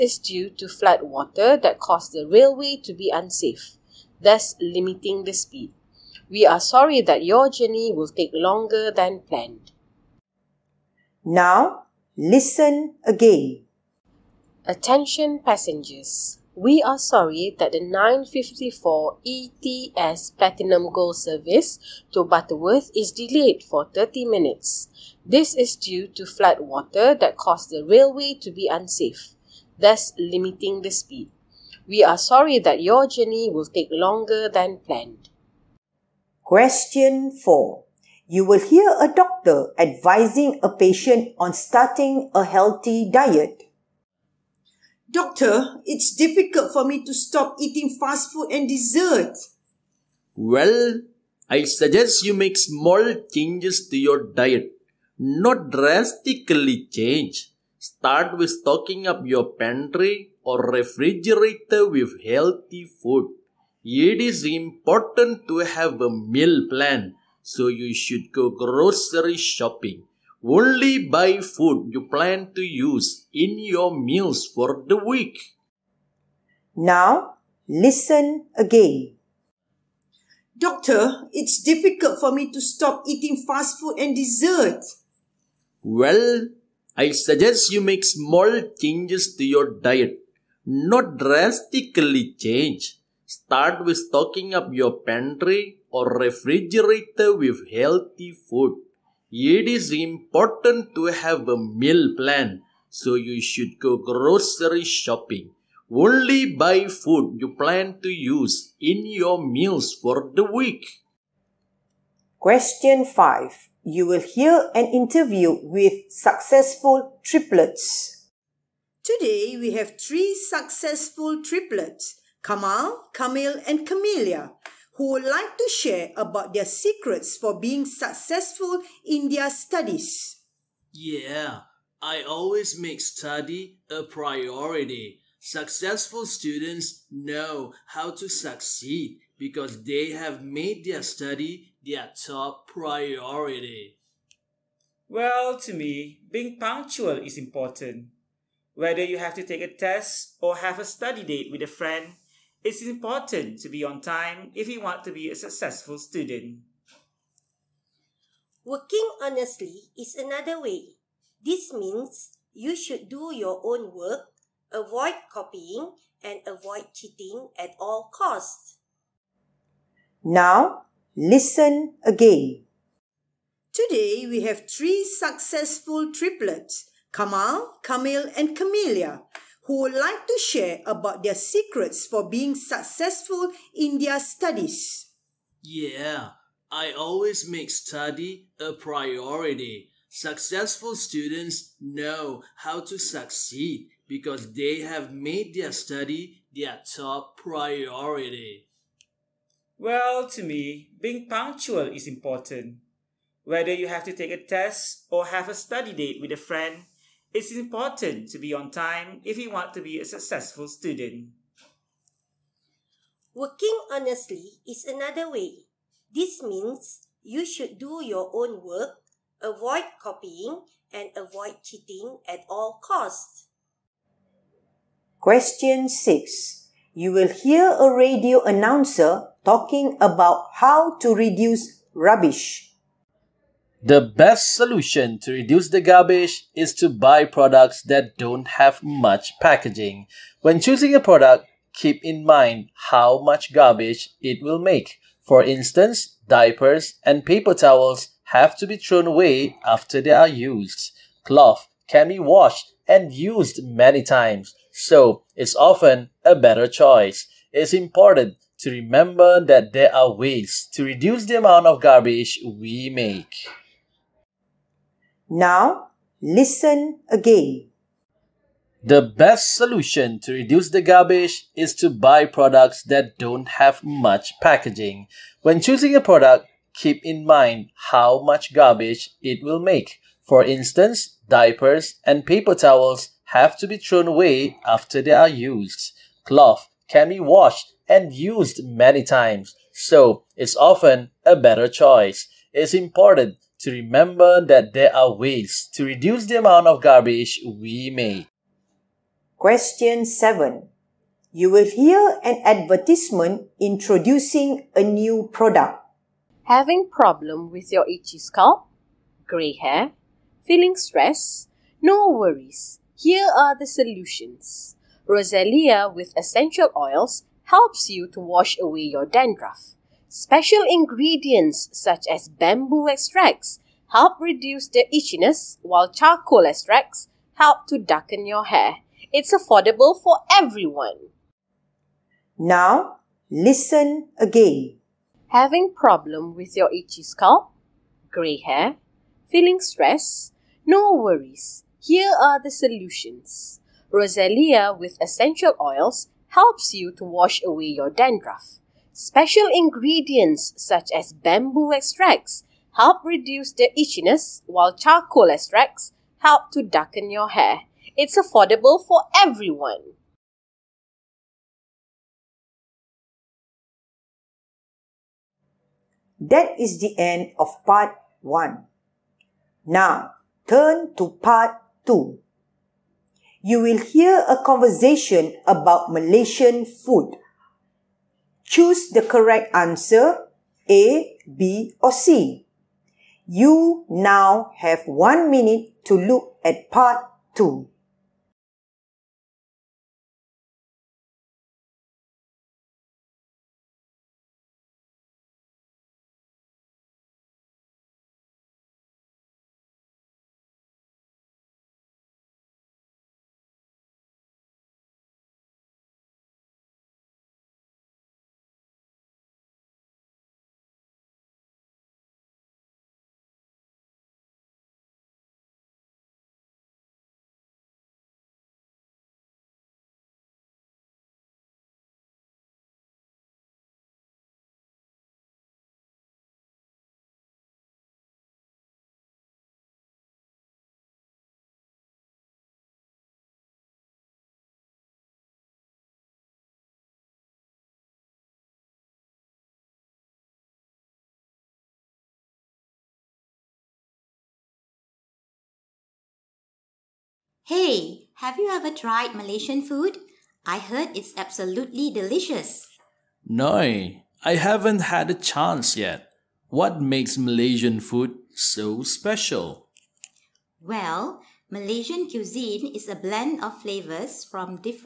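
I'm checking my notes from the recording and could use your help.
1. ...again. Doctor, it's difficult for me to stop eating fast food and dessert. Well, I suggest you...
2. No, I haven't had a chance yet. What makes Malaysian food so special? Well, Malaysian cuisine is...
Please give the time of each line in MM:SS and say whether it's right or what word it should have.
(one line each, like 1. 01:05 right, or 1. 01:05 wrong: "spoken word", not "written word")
1. 01:18 right
2. 07:33 right.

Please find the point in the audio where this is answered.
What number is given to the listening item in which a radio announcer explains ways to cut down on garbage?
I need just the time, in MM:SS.
03:45.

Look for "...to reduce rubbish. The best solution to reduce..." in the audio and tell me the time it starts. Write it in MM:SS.
03:50.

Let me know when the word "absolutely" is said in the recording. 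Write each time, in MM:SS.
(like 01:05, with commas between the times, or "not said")
07:31.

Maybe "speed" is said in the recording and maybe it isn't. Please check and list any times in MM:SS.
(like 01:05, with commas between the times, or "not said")
00:05, 00:30.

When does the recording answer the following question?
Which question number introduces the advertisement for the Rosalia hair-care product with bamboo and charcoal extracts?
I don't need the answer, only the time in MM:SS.
05:00.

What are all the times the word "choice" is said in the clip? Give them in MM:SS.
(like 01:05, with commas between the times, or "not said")
04:16, 04:51.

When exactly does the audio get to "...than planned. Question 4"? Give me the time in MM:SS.
00:34.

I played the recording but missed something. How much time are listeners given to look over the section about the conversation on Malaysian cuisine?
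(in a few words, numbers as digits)
one minute.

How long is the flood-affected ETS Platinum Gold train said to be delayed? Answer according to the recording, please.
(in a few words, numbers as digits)
30 minutes.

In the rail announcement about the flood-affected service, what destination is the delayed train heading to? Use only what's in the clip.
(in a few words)
Butterworth.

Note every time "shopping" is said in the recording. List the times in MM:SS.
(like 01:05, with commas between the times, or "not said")
01:09, 01:44.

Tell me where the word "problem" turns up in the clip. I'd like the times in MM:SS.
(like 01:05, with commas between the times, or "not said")
05:06, 05:35.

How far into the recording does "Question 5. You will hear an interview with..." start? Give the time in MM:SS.
01:52.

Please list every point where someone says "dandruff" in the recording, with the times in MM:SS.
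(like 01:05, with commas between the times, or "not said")
05:19, 05:47.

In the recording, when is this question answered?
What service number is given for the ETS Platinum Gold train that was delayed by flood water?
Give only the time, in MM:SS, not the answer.
00:17.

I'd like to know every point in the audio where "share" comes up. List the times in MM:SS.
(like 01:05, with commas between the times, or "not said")
02:05, 03:00.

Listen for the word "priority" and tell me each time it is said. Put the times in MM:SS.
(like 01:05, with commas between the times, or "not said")
02:14, 02:22, 03:08, 03:17.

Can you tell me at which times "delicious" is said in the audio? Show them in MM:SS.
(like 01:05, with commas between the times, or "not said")
07:31.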